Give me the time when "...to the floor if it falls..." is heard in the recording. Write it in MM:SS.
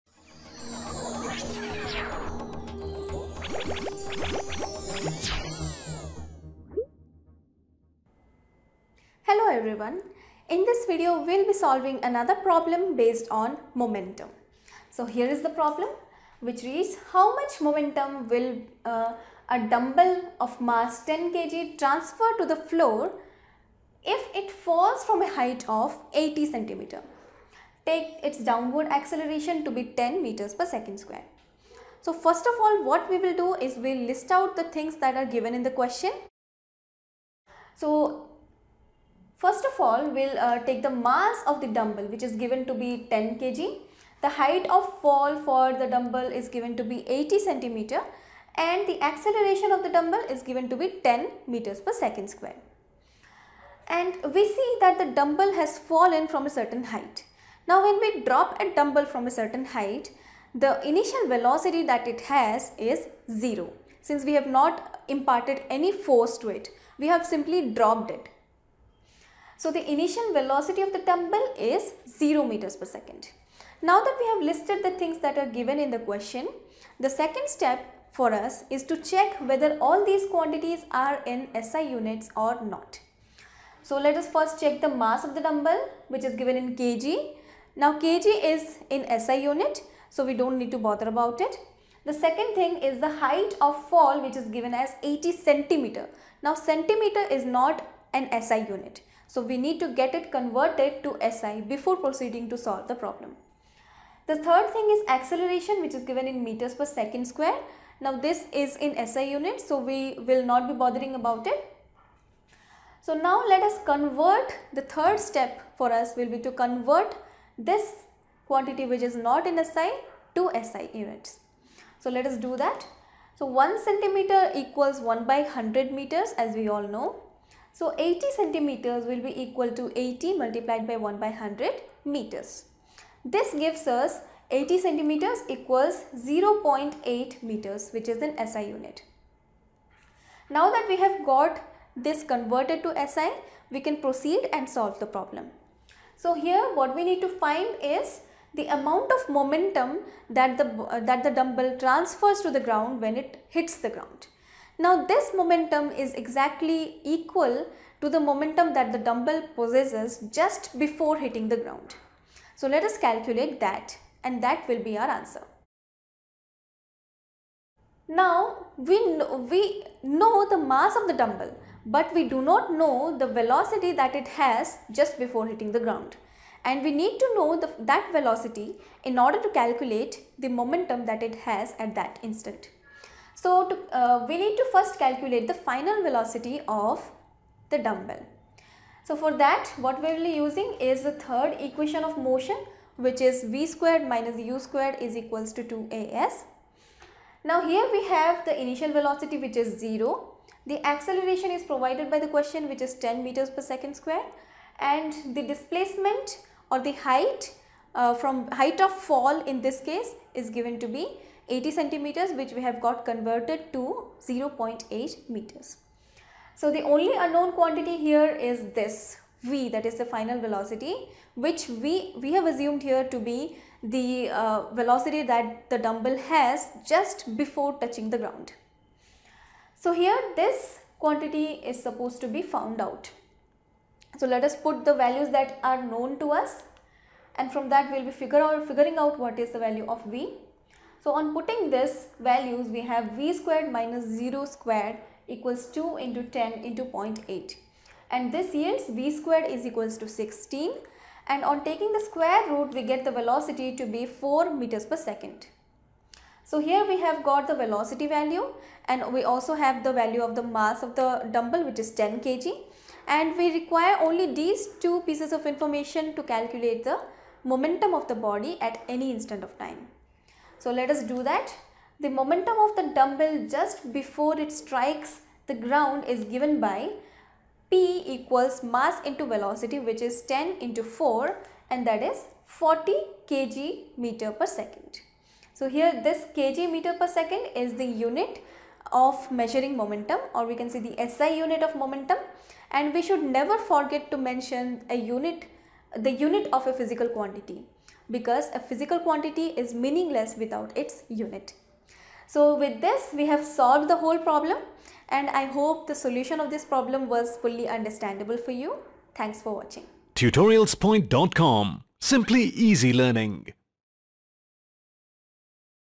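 00:22.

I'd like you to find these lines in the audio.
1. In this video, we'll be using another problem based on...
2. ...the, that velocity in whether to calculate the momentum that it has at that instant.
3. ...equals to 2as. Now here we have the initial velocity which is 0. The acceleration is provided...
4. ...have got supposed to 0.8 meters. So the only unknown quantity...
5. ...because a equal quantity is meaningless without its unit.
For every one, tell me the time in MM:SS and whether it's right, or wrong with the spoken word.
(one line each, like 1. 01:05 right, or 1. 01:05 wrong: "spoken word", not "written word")
1. 00:10 wrong: "solving", not "using"
2. 02:57 wrong: "order", not "whether"
3. 03:15 right
4. 03:32 wrong: "converted", not "supposed"
5. 04:58 wrong: "physical", not "equal".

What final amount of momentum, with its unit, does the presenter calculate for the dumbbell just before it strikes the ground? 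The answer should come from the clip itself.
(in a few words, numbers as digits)
40 kg m/s.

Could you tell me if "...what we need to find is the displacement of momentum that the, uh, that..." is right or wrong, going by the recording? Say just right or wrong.
wrong.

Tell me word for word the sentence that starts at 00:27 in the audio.
Take its downward acceleration to be 10 meters per second square.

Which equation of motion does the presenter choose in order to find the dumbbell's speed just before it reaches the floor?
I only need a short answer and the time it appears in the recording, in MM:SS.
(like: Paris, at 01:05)
third equation of motion, at 03:11.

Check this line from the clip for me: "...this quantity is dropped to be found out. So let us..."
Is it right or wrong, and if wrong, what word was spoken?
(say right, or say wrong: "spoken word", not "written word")
wrong: "supposed", not "dropped".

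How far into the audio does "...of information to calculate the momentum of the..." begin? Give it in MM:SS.
04:25.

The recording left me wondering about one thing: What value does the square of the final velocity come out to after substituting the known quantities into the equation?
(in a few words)
16.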